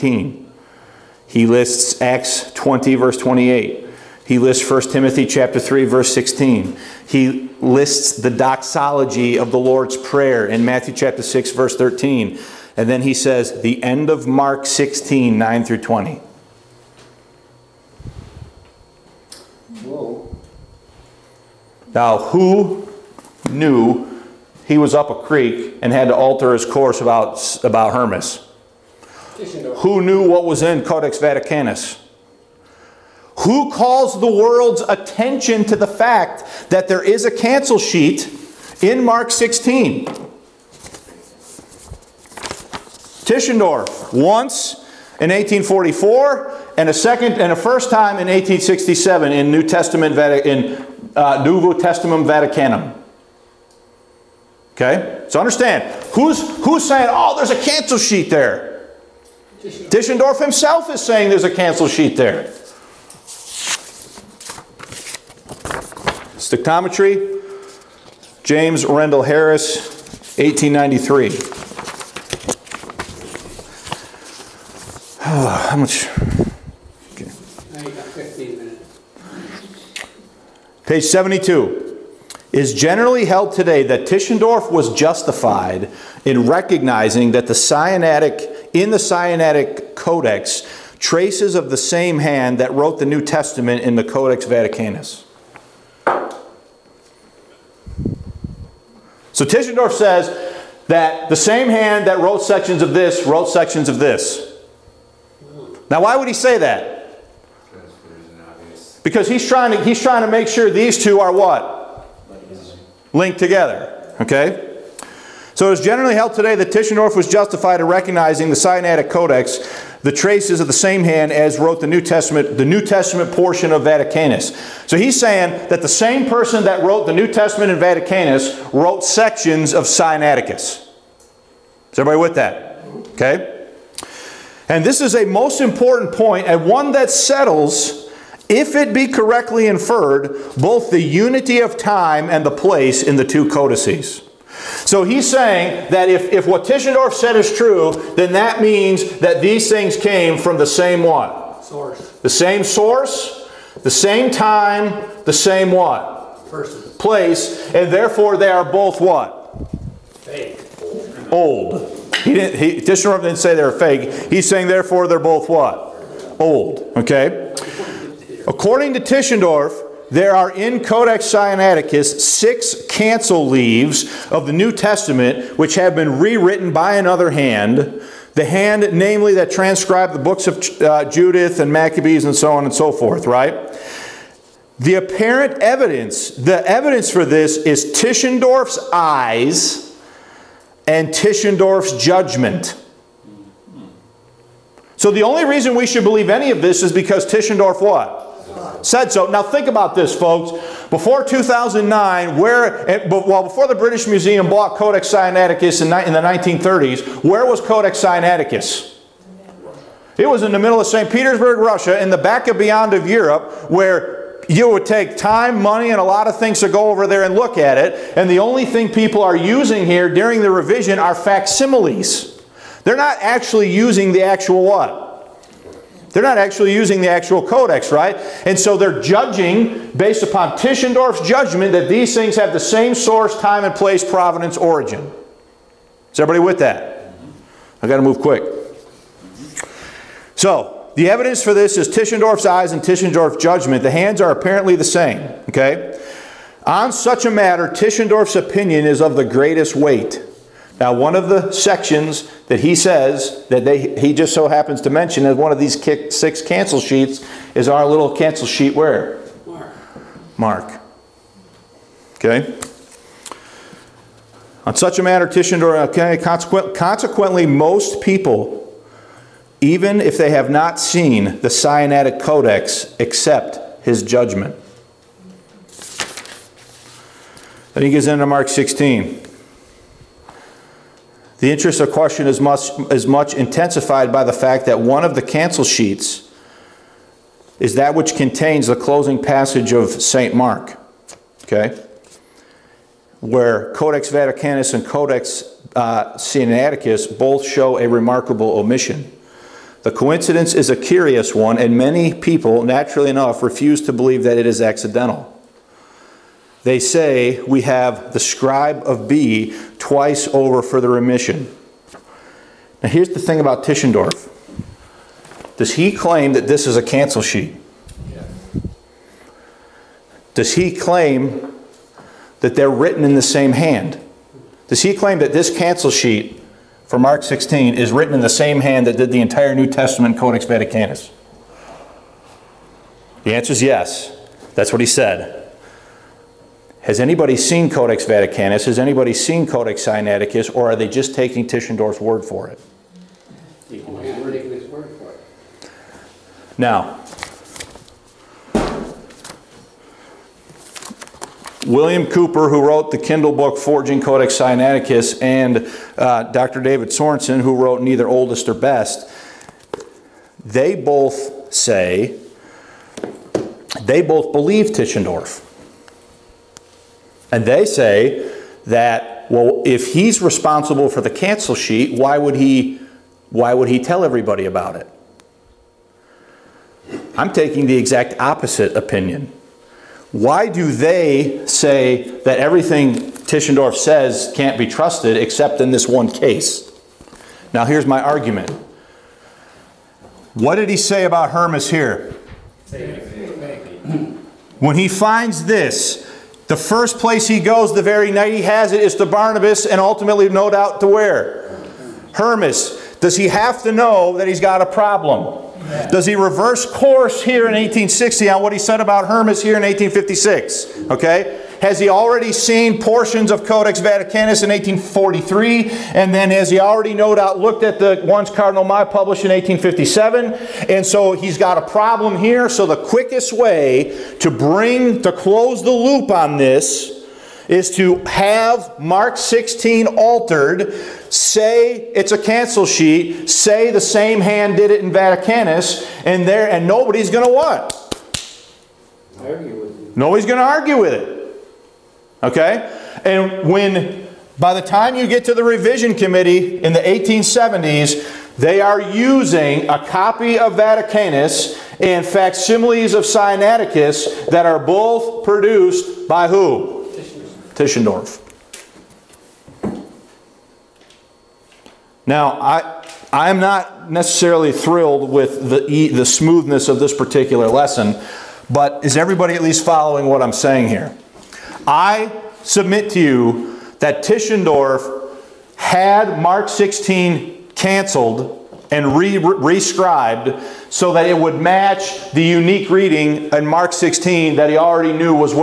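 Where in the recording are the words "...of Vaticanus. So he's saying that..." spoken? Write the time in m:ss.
2:03.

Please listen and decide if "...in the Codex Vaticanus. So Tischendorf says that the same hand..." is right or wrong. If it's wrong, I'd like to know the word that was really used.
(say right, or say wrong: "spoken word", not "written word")
right.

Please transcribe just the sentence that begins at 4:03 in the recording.
The hands are apparently the same, okay?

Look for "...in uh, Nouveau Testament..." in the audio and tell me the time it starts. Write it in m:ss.
0:50.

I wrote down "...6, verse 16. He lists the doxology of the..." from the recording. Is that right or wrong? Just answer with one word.
wrong.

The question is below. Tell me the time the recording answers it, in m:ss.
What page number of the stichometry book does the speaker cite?
1:20.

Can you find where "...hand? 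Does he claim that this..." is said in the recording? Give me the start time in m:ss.
5:23.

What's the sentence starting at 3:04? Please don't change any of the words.
The apparent evidence, the evidence for this is Tischendorf's eyes and Tischendorf's judgment.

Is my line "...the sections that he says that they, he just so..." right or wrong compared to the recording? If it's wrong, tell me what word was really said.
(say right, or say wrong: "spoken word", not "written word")
right.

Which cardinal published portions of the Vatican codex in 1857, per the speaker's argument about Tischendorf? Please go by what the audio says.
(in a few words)
Cardinal Mai.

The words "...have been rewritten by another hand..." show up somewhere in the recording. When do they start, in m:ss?
2:55.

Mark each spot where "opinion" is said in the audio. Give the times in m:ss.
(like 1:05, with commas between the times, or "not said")
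4:08, 6:18.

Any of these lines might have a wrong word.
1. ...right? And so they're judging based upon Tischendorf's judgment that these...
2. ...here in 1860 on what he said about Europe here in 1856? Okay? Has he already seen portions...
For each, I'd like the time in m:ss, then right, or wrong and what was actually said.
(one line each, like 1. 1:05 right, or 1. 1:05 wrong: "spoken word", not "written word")
1. 3:47 right
2. 6:47 wrong: "Hermas", not "Europe".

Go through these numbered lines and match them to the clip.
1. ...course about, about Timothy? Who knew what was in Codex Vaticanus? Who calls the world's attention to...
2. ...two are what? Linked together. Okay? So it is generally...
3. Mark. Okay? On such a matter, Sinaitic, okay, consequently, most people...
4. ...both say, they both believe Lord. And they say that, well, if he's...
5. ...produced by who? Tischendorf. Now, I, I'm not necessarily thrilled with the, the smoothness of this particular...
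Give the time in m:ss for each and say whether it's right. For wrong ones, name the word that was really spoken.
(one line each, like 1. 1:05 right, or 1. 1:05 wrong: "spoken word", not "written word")
1. 0:26 wrong: "Hermas", not "Timothy"
2. 1:51 right
3. 4:20 wrong: "Tischendorf", not "Sinaitic"
4. 6:00 wrong: "Tischendorf", not "Lord"
5. 7:35 right.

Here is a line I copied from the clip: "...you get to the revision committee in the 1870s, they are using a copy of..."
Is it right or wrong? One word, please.
right.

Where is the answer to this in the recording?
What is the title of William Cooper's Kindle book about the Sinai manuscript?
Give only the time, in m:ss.
5:53.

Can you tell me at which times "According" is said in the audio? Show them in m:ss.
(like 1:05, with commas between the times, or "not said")
2:48.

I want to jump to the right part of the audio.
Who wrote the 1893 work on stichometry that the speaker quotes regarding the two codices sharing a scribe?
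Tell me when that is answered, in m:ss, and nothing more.
1:08.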